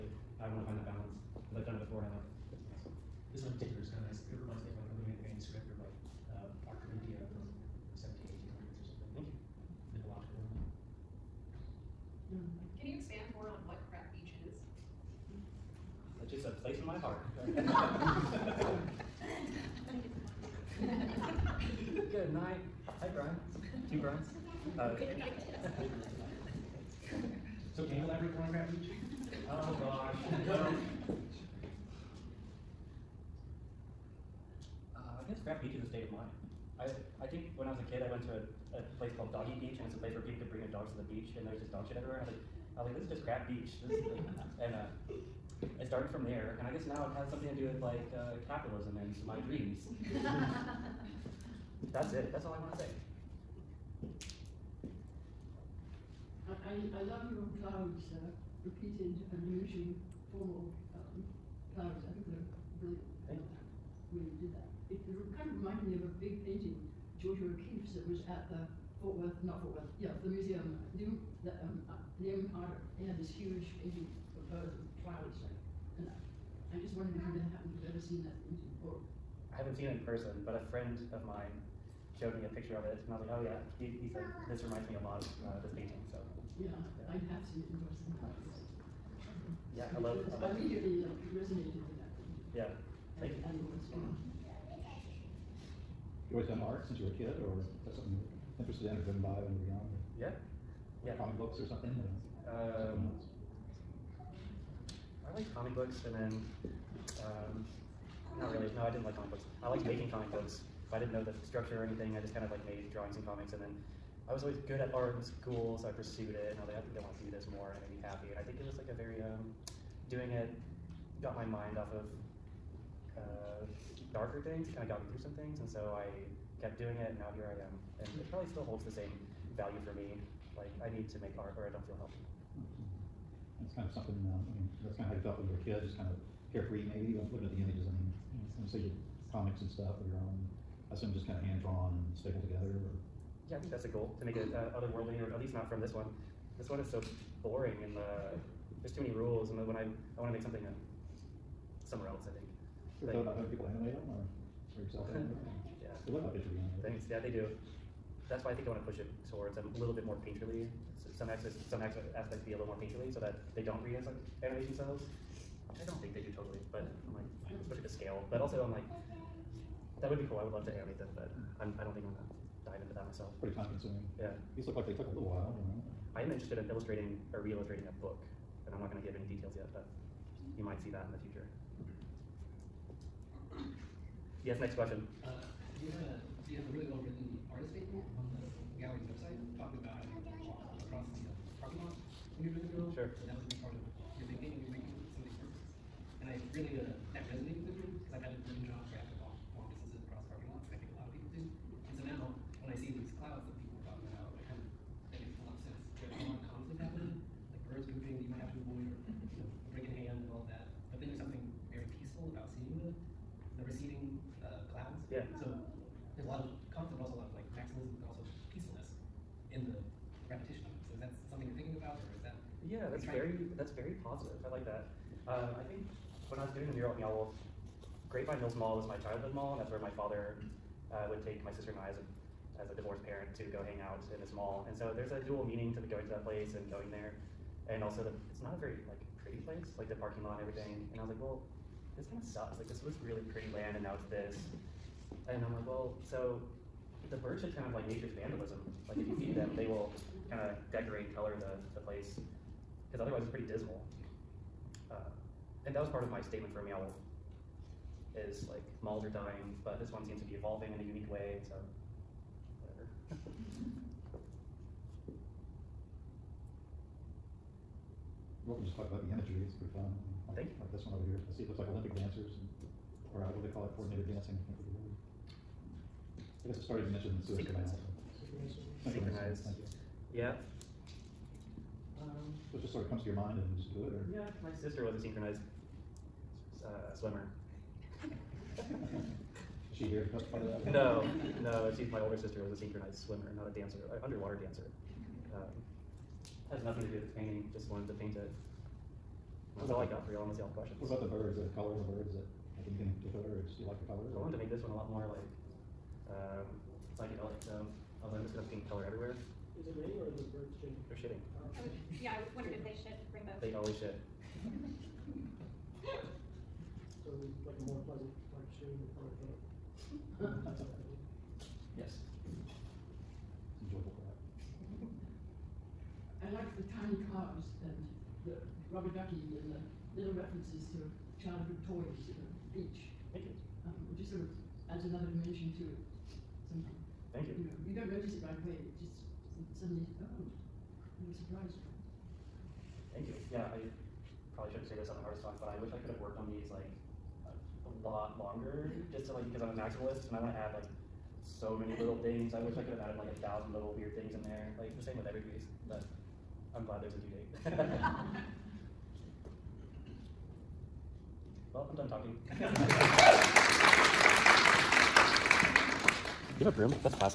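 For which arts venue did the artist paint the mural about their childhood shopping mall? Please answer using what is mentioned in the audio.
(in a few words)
Meow Wolf.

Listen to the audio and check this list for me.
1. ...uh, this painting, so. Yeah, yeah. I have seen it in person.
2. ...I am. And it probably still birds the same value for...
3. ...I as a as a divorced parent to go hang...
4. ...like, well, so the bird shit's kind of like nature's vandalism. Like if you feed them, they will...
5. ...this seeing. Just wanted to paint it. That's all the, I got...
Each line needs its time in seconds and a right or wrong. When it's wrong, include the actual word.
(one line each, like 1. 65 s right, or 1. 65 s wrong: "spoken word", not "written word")
1. 85 s right
2. 127 s wrong: "holds", not "birds"
3. 231 s right
4. 245 s right
5. 297 s wrong: "painting", not "seeing".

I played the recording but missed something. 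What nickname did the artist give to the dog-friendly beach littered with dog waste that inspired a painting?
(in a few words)
Crap Beach.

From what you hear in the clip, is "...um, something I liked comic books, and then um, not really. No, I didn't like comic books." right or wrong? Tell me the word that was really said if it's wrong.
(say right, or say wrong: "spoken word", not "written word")
right.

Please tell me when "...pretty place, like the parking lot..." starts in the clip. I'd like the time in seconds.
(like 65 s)
239 s.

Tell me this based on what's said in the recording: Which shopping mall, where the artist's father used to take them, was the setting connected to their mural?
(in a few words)
Grapevine Mills Mall.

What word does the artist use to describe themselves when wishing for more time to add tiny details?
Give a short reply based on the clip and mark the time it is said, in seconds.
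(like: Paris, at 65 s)
A maximalist, at 349 s.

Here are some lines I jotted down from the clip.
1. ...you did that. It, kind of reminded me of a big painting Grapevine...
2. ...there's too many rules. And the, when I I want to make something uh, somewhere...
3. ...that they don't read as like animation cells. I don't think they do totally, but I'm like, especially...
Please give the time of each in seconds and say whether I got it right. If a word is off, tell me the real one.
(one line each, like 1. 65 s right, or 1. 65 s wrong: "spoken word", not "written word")
1. 64 s wrong: "Georgia", not "Grapevine"
2. 148 s right
3. 163 s right.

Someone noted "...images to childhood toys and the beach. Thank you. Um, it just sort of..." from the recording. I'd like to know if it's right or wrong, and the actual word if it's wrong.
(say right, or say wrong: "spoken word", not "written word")
wrong: "references", not "images".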